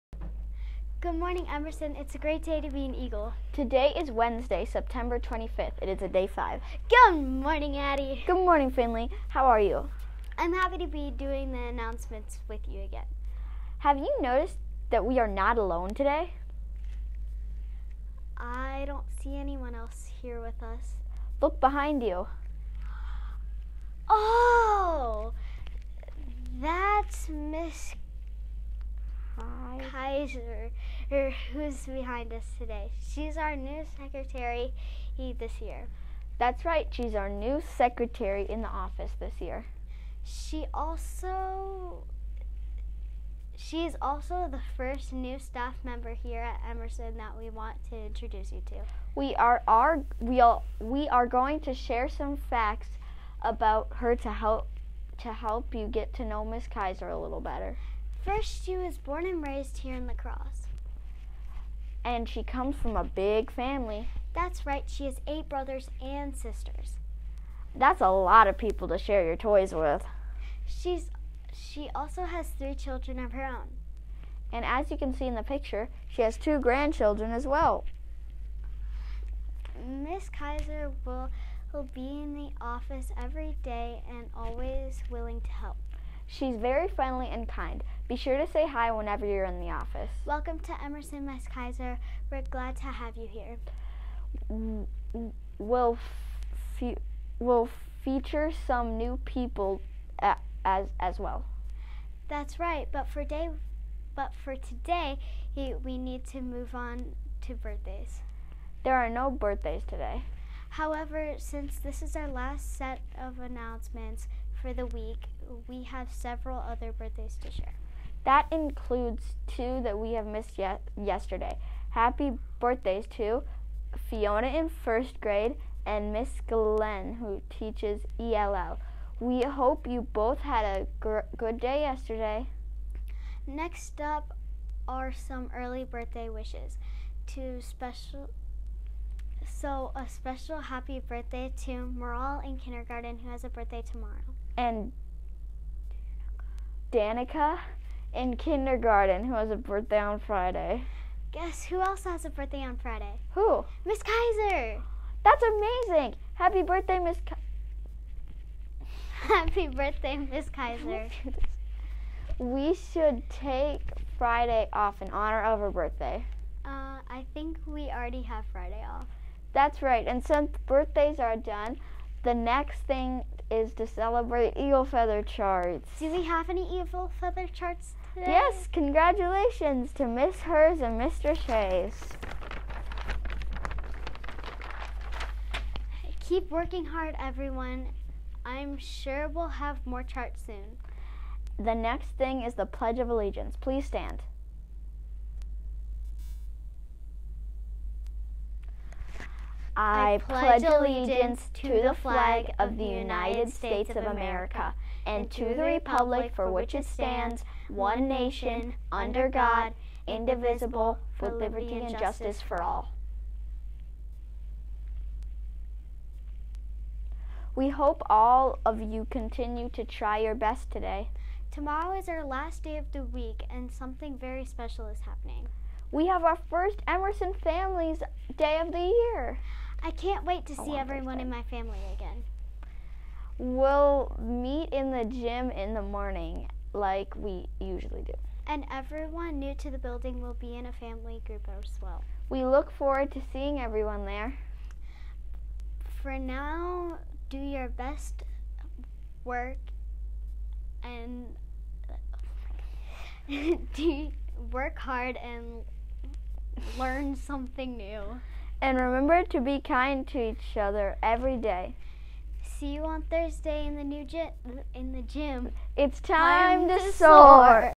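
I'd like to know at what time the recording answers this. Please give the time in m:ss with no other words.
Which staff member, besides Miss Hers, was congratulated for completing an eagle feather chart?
3:00.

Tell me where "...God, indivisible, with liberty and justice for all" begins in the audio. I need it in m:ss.
3:29.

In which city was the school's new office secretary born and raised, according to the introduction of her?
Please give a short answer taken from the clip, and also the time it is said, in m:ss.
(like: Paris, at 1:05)
La Crosse, at 1:00.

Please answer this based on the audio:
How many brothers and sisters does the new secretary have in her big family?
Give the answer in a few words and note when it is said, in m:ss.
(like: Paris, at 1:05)
8, at 1:05.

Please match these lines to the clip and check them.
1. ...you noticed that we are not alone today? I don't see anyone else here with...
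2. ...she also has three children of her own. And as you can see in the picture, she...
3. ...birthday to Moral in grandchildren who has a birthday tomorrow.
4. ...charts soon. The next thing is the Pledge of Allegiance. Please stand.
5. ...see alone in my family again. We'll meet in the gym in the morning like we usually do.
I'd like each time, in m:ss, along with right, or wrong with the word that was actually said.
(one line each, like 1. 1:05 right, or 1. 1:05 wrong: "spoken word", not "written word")
1. 0:13 right
2. 1:11 right
3. 2:21 wrong: "kindergarten", not "grandchildren"
4. 3:10 right
5. 3:50 wrong: "everyone", not "alone".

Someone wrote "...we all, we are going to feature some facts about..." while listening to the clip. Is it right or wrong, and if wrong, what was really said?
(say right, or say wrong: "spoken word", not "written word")
wrong: "share", not "feature".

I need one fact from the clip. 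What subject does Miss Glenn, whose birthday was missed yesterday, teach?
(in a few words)
ELL.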